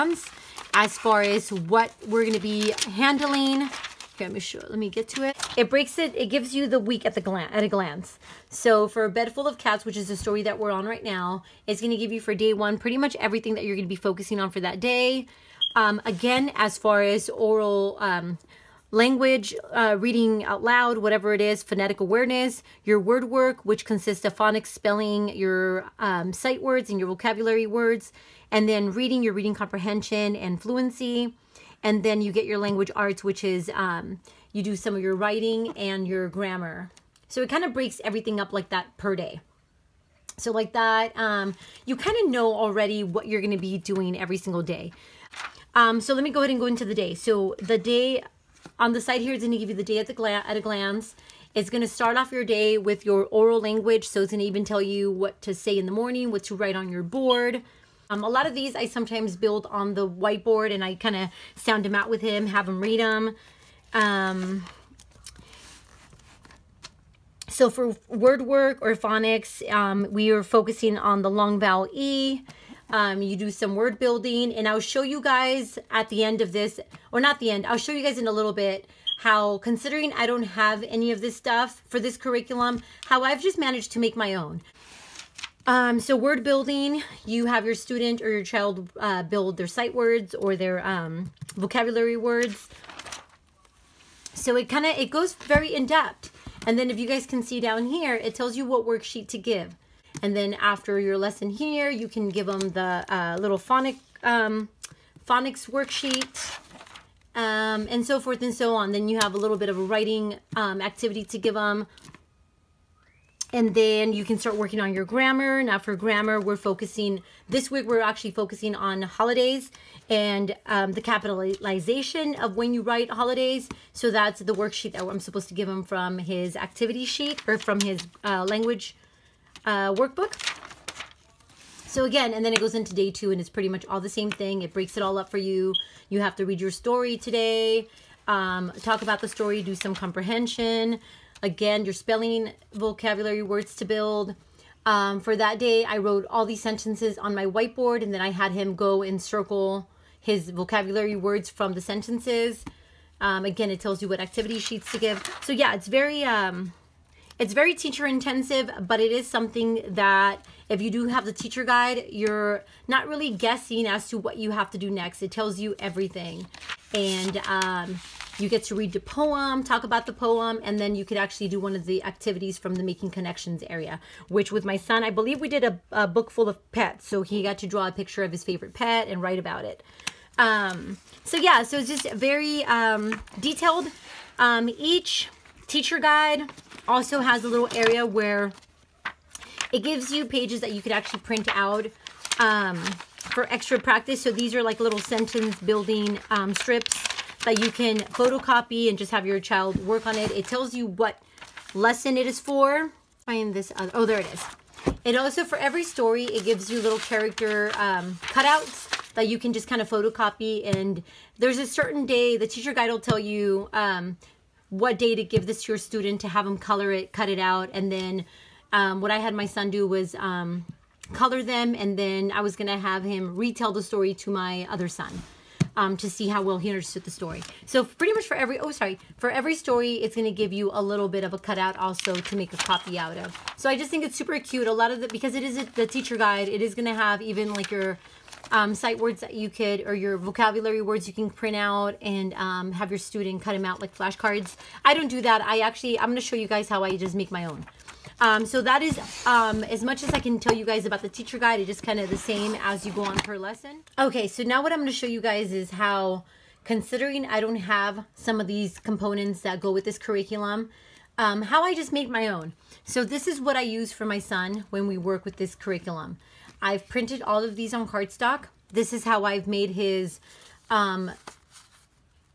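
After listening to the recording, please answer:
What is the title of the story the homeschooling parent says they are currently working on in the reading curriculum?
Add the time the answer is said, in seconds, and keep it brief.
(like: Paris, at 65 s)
A Bed Full of Cats, at 9 s.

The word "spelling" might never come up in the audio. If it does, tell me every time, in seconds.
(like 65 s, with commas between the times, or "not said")
24 s, 141 s.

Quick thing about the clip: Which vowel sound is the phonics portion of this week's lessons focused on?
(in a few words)
long vowel E.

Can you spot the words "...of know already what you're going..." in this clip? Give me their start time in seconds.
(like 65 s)
42 s.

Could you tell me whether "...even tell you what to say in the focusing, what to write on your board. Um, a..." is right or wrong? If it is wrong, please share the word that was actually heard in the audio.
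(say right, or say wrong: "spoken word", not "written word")
wrong: "morning", not "focusing".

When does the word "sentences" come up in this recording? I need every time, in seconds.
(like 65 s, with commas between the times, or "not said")
146 s, 151 s, 194 s.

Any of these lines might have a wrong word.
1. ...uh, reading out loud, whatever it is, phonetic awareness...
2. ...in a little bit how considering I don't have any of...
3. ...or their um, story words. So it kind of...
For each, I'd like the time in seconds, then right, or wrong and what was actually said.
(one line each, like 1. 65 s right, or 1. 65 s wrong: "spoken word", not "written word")
1. 19 s right
2. 78 s right
3. 90 s wrong: "vocabulary", not "story".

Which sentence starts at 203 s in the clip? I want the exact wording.
Find this other, oh, there it is.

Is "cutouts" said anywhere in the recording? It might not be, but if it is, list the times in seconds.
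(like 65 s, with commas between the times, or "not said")
208 s, 231 s.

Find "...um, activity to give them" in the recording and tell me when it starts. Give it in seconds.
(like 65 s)
110 s.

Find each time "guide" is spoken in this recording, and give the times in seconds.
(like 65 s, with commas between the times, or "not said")
161 s, 185 s, 212 s, 236 s, 251 s.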